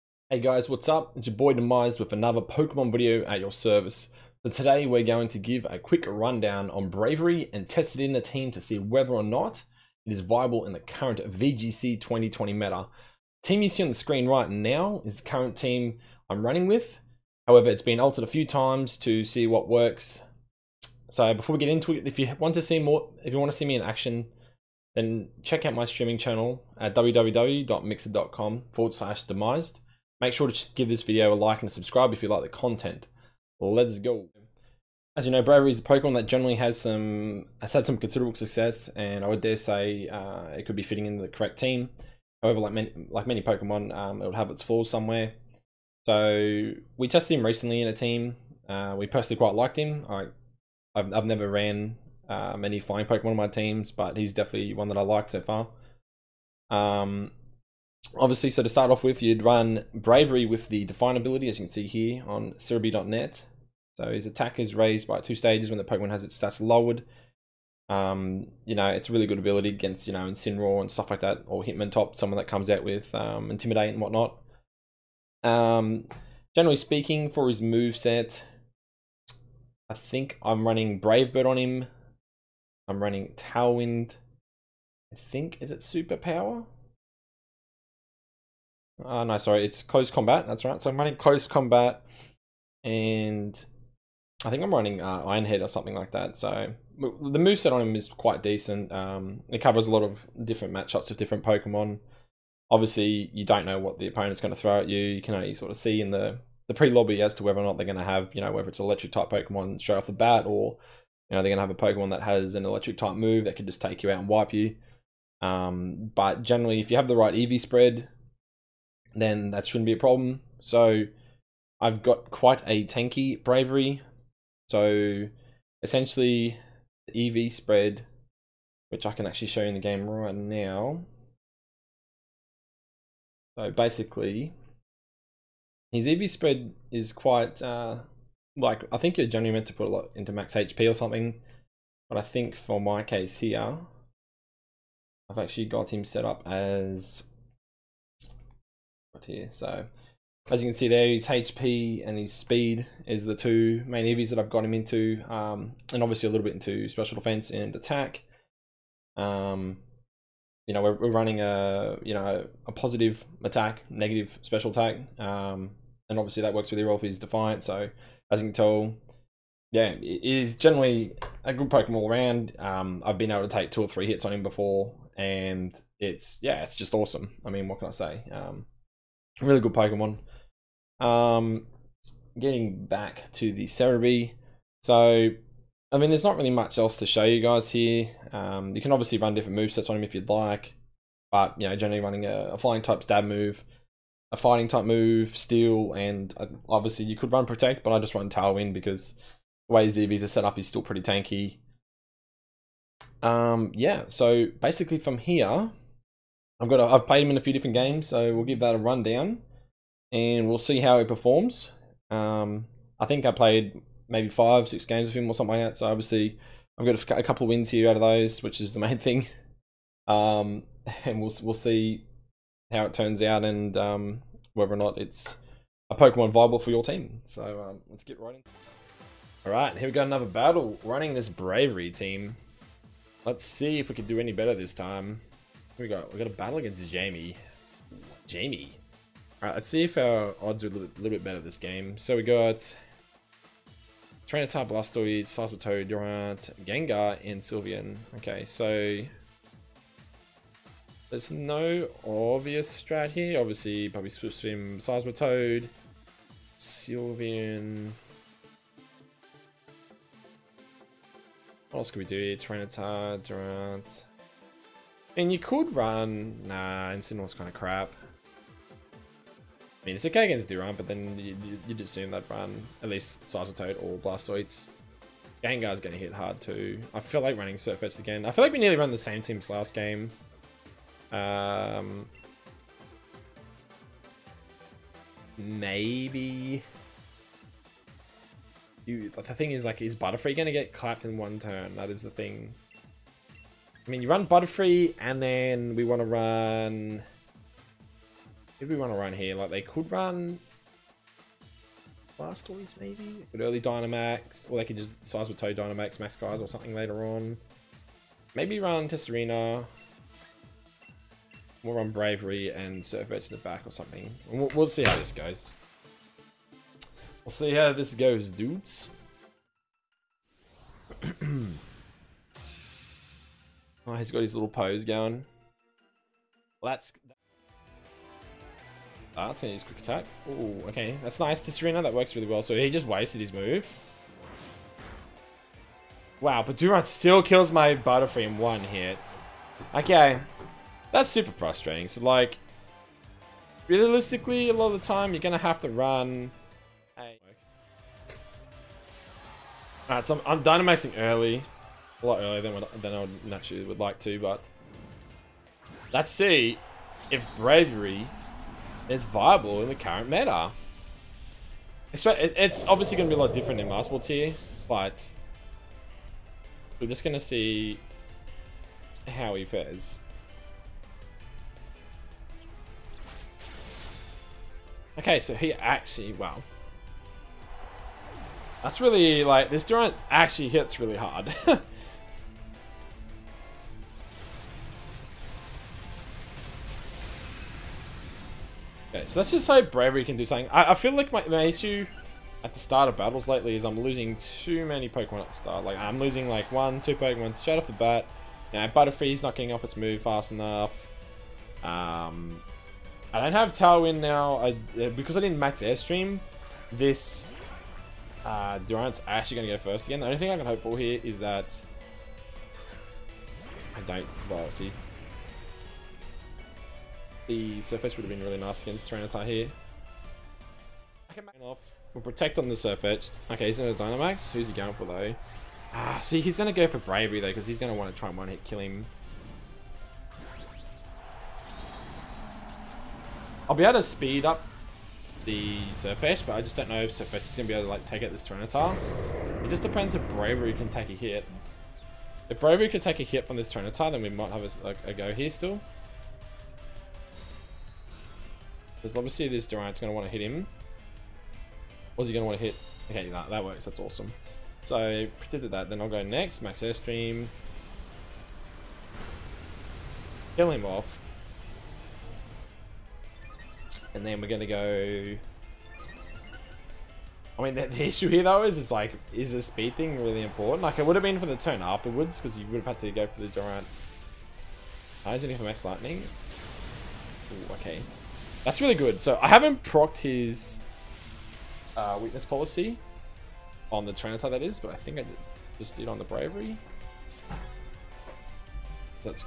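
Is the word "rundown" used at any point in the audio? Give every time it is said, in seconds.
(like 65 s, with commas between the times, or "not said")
6 s, 208 s.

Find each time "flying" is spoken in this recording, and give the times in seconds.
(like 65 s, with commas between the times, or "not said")
52 s, 192 s.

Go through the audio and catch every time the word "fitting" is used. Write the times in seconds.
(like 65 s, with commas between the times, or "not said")
40 s.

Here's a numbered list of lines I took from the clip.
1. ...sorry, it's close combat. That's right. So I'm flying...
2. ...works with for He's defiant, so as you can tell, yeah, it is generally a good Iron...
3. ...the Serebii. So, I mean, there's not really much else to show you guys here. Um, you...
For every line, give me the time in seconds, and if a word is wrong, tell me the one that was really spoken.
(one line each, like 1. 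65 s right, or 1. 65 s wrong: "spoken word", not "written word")
1. 89 s wrong: "running", not "flying"
2. 166 s wrong: "Pokemon", not "Iron"
3. 183 s right.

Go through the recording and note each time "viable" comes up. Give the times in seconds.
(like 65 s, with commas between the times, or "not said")
10 s, 226 s, 359 s.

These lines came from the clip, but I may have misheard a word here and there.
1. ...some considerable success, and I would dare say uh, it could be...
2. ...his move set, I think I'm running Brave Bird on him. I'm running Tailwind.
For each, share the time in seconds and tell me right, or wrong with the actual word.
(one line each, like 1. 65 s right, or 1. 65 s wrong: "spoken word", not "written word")
1. 37 s right
2. 77 s right.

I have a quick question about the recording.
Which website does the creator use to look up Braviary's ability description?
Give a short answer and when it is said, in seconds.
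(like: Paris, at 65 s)
Serebii.net, at 62 s.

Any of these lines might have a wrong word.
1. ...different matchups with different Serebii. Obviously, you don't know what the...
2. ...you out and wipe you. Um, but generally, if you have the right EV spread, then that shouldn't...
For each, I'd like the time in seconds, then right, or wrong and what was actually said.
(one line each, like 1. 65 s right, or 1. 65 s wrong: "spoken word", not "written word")
1. 100 s wrong: "Pokemon", not "Serebii"
2. 114 s right.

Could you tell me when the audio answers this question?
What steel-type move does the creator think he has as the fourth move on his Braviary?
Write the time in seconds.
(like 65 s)
95 s.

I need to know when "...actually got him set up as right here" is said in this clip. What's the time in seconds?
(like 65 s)
145 s.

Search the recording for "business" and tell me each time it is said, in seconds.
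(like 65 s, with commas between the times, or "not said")
not said.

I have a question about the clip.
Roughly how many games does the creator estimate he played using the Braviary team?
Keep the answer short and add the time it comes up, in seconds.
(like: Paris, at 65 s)
5 or 6, at 214 s.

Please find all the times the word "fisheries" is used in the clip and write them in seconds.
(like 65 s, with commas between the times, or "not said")
not said.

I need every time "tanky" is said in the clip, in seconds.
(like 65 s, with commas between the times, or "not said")
122 s, 201 s.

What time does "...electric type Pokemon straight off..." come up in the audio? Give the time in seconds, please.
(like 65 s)
108 s.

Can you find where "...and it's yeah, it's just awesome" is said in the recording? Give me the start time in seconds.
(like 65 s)
175 s.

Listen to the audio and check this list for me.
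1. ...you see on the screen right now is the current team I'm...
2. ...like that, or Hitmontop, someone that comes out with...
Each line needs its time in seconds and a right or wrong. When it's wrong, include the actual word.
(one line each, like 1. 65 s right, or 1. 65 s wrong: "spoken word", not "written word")
1. 13 s right
2. 71 s right.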